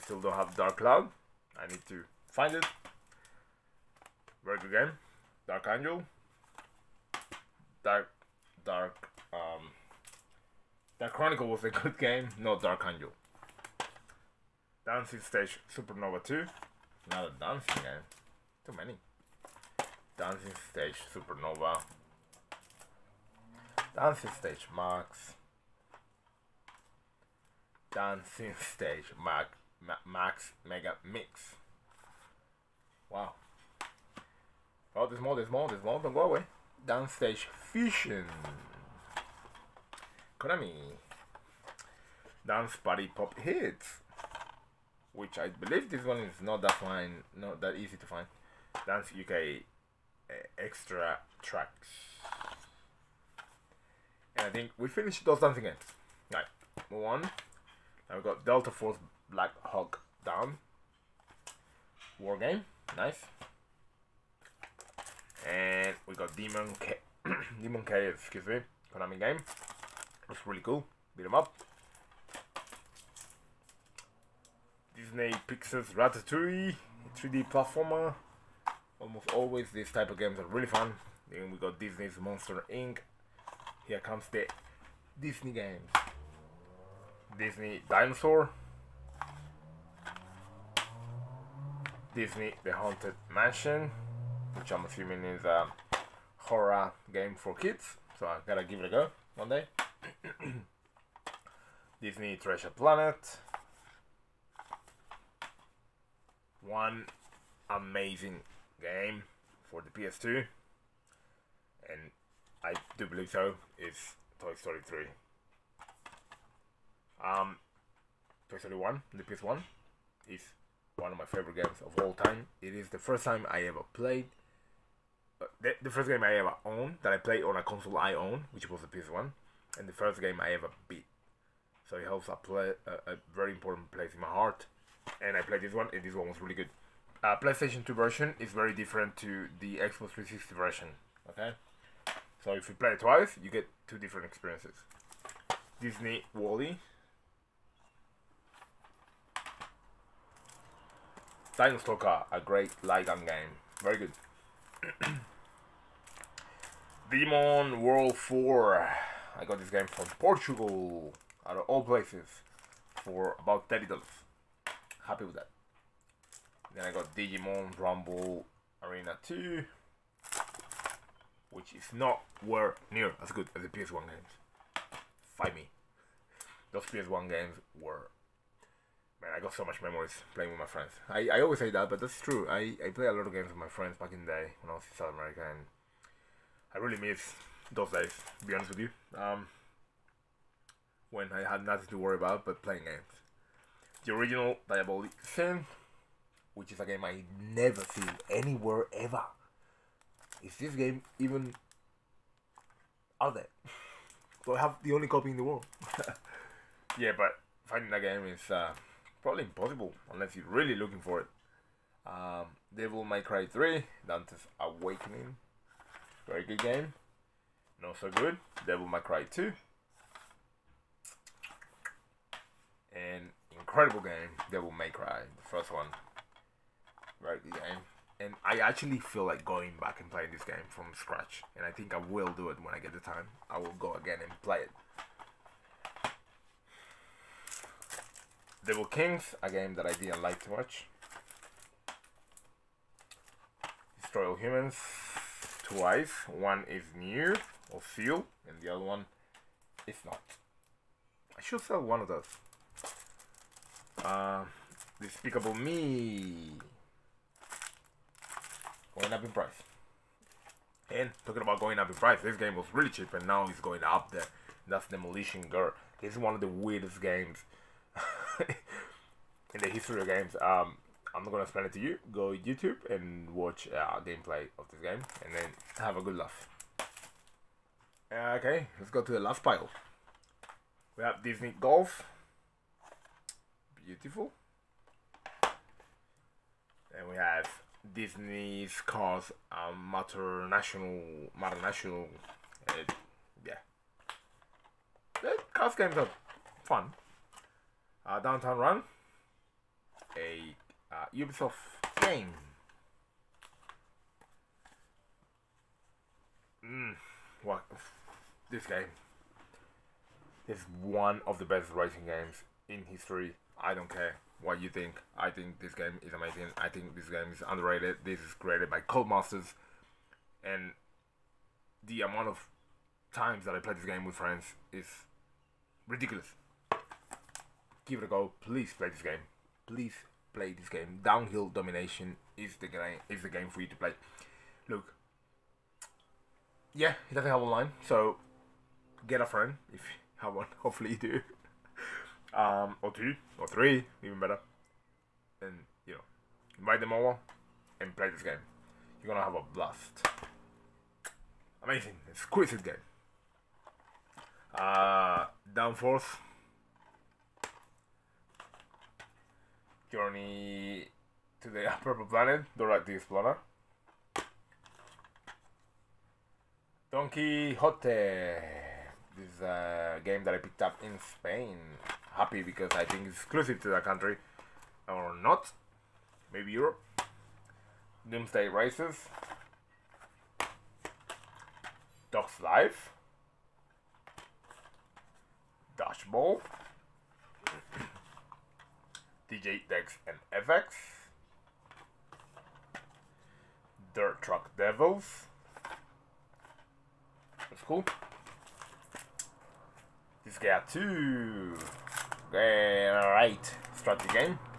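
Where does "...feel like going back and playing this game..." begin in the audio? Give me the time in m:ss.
3:48.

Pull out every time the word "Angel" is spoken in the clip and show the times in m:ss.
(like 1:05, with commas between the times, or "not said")
0:05, 0:12.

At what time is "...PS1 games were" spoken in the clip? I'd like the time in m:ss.
2:56.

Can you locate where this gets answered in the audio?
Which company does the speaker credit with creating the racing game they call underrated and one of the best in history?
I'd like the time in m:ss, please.
5:18.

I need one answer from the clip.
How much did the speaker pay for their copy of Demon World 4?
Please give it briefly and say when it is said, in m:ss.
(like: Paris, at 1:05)
$30, at 2:43.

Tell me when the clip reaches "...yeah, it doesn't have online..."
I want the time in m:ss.
5:36.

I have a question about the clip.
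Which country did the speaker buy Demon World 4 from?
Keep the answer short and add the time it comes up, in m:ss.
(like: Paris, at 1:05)
Portugal, at 2:40.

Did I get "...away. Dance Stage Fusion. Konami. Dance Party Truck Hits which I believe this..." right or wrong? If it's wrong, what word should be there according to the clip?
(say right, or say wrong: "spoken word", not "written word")
wrong: "Pop", not "Truck".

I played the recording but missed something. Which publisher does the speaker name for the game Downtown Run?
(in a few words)
Ubisoft.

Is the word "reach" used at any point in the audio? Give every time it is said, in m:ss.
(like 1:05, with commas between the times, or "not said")
not said.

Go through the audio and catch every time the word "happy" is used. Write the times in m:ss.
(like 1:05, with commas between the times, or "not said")
2:45, 6:12.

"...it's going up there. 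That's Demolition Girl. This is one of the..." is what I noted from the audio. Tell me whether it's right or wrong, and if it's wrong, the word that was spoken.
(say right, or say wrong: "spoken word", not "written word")
right.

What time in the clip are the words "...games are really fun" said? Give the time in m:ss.
1:20.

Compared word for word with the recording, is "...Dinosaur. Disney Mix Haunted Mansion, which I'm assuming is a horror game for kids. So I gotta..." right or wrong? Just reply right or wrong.
wrong.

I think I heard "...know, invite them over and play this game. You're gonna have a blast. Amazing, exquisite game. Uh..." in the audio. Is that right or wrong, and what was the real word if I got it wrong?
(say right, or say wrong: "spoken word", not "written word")
right.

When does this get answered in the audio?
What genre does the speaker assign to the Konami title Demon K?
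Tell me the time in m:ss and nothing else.
1:11.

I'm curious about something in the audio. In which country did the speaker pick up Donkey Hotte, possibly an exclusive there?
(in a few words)
Spain.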